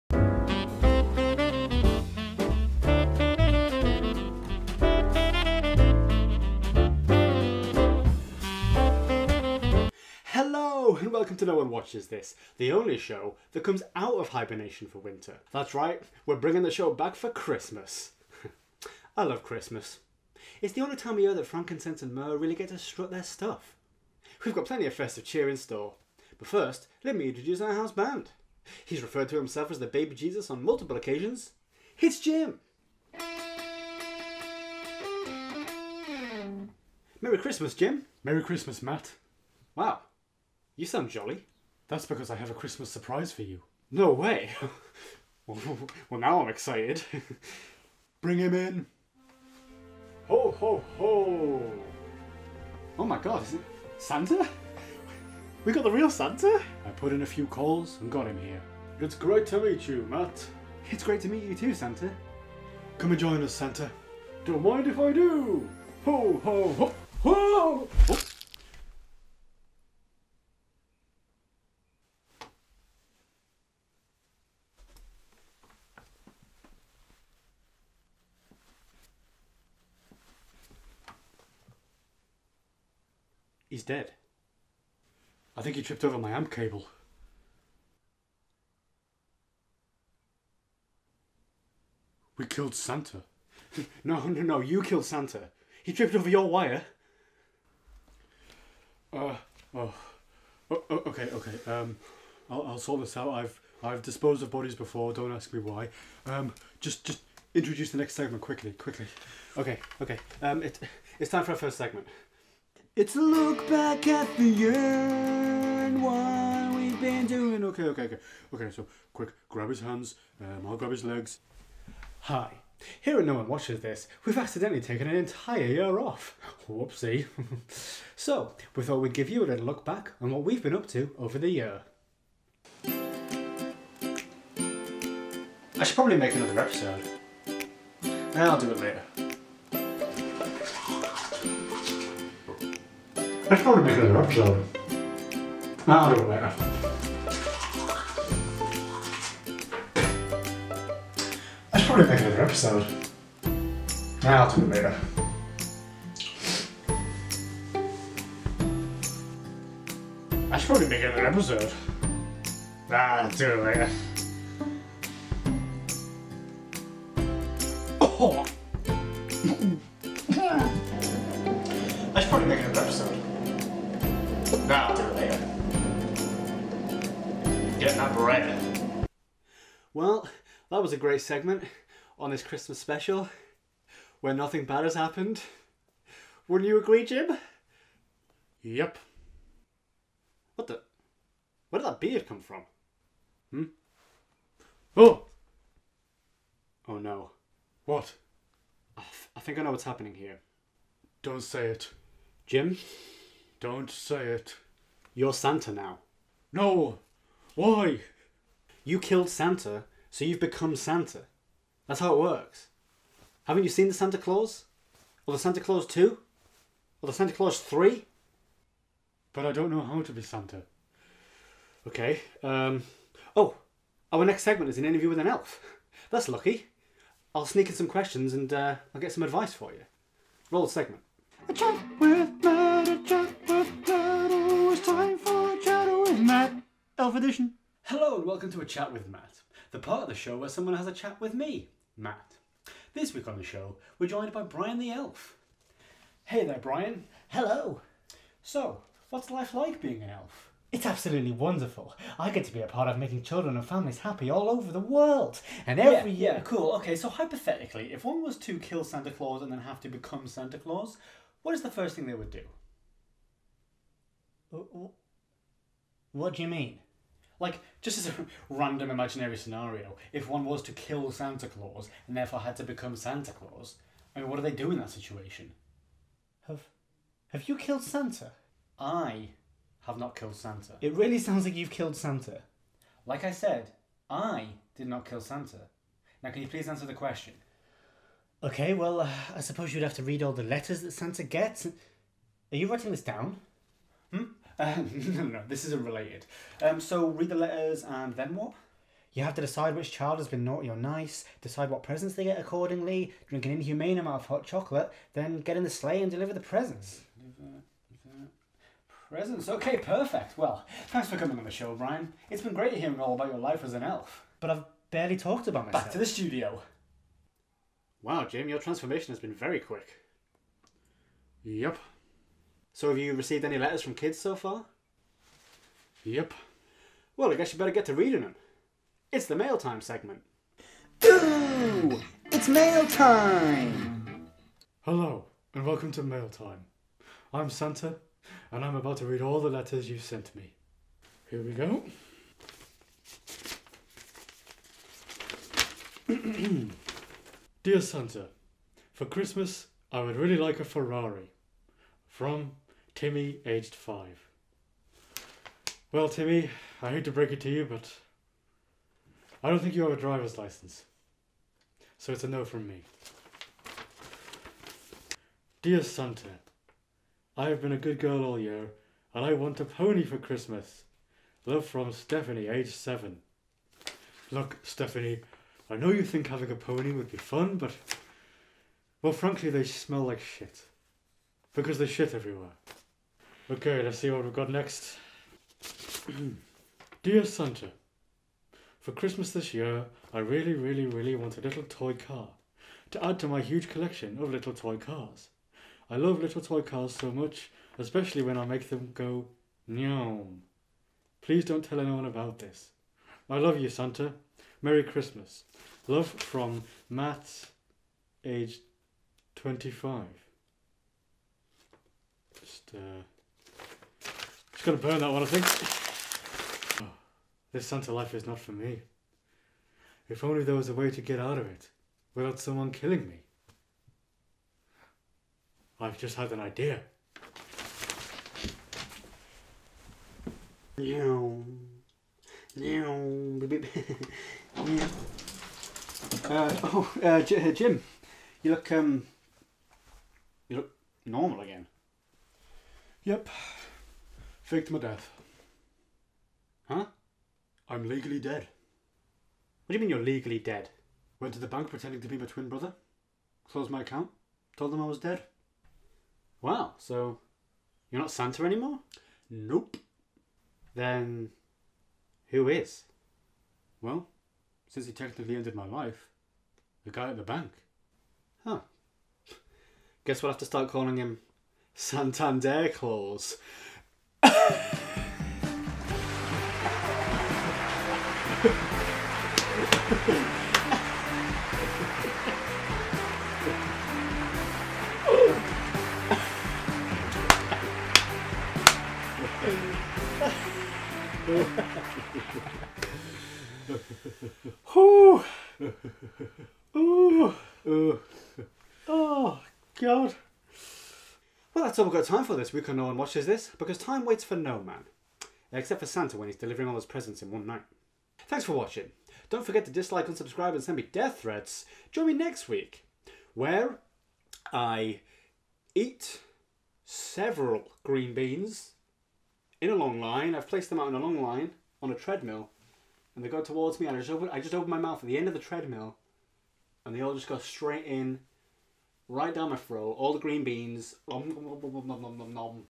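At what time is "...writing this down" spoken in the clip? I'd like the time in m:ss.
4:52.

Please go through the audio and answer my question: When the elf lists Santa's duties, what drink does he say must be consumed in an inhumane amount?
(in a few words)
hot chocolate.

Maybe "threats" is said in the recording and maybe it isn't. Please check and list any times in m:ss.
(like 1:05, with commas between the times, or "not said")
8:31.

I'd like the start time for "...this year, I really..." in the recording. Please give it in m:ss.
6:29.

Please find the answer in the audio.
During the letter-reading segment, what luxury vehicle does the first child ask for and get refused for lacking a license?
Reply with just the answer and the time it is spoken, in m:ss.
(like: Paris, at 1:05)
Ferrari, at 5:50.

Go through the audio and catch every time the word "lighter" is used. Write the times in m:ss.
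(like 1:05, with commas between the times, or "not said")
not said.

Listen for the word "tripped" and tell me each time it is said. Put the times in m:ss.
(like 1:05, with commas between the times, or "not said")
1:25, 1:35.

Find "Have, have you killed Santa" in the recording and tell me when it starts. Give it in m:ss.
4:36.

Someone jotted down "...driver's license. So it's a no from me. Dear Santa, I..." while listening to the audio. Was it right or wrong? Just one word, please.
right.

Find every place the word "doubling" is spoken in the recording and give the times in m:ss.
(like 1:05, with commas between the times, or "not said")
not said.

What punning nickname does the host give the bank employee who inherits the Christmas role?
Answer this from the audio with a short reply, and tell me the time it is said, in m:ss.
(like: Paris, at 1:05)
Santander Claus, at 7:51.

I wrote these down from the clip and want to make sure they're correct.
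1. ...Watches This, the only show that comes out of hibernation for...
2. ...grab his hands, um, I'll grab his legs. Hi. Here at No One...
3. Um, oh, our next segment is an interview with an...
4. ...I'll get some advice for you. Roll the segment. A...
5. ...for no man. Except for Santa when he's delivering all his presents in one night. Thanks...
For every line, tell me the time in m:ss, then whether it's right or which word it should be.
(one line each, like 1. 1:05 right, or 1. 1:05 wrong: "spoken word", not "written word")
1. 0:11 right
2. 1:59 right
3. 3:42 right
4. 3:48 right
5. 8:24 right.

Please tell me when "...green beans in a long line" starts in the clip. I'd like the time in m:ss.
8:37.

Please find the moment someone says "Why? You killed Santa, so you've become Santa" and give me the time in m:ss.
3:27.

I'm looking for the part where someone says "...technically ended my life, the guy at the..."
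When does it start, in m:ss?
7:44.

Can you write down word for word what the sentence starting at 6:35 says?
I love little toy cars so much, especially when I make them go nyom.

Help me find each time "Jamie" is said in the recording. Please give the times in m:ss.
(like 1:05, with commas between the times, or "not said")
5:18.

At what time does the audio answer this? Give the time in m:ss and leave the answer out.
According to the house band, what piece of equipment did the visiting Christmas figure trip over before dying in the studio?
1:26.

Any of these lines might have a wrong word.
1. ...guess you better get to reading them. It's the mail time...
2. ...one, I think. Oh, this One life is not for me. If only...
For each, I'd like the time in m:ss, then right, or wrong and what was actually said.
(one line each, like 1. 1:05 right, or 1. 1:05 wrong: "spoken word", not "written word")
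1. 5:27 right
2. 6:55 wrong: "Santa", not "One".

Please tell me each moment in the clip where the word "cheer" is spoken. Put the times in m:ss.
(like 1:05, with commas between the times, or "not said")
0:25.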